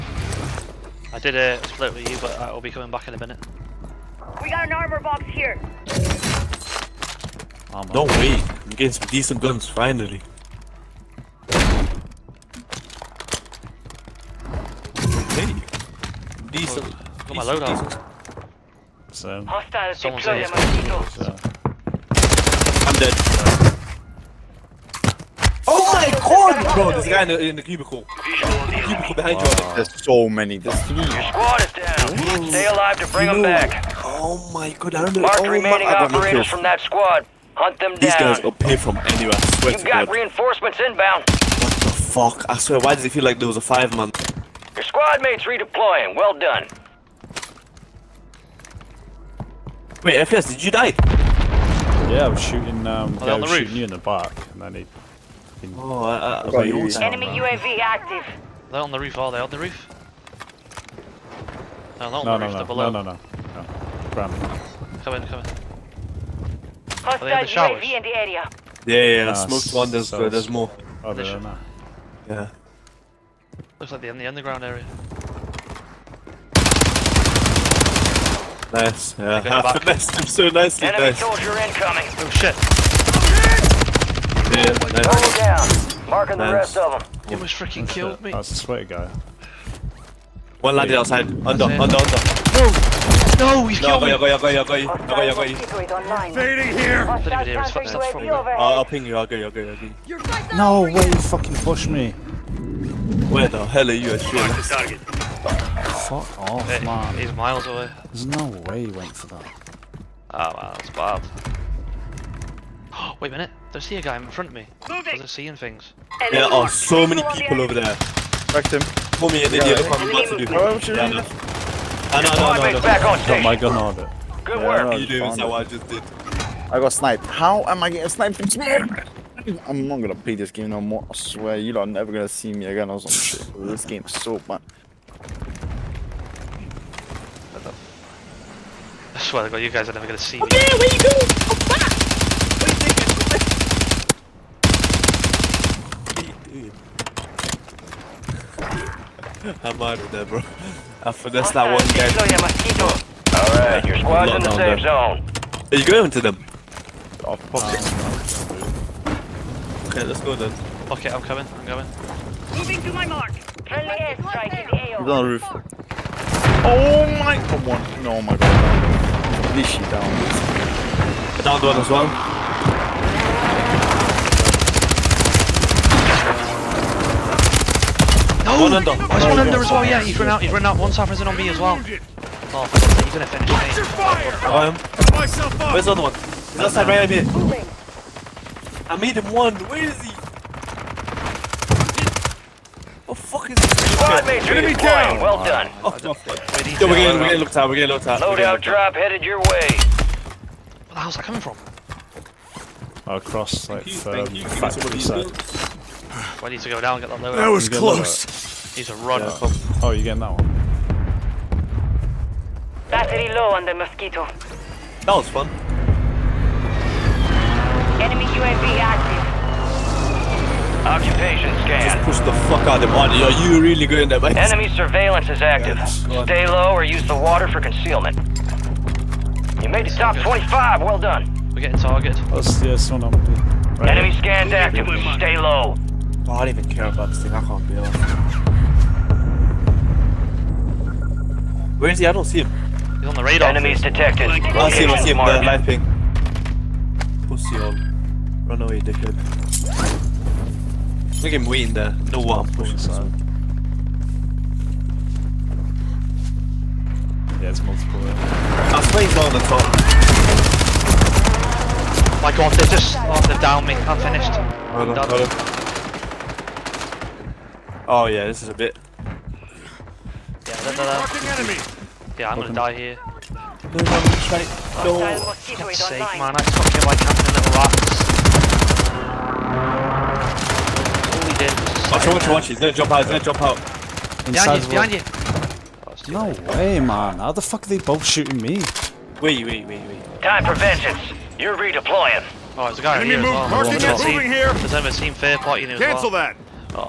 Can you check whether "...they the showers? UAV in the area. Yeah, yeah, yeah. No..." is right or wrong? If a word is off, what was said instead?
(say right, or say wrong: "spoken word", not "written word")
right.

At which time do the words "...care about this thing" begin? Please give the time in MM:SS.
03:56.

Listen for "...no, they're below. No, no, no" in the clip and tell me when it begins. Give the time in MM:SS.
01:02.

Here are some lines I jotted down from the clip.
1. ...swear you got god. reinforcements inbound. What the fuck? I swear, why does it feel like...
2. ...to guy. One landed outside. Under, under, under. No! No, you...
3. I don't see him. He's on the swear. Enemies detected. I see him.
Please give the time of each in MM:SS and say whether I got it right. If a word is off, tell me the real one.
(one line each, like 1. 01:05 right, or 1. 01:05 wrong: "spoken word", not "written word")
1. 00:39 right
2. 01:28 right
3. 04:02 wrong: "radar", not "swear".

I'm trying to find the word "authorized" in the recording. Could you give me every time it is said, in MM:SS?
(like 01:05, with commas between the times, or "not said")
not said.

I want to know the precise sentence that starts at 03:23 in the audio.
Uh, across like thank um, factory side.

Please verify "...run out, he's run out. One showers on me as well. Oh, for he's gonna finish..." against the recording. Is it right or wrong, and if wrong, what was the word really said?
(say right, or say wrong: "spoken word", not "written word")
wrong: "suffers", not "showers".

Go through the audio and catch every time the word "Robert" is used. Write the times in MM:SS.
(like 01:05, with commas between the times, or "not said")
not said.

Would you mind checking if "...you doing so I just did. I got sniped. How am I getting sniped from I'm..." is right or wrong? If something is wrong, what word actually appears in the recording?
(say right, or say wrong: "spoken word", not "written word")
right.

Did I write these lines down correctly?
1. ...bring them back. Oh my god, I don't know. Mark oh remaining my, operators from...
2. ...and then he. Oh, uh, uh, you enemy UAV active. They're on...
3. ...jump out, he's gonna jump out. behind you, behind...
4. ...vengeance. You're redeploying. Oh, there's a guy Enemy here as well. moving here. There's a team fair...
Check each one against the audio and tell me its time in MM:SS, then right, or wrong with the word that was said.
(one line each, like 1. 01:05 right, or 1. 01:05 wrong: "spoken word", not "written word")
1. 00:33 right
2. 00:54 right
3. 04:42 right
4. 04:50 right.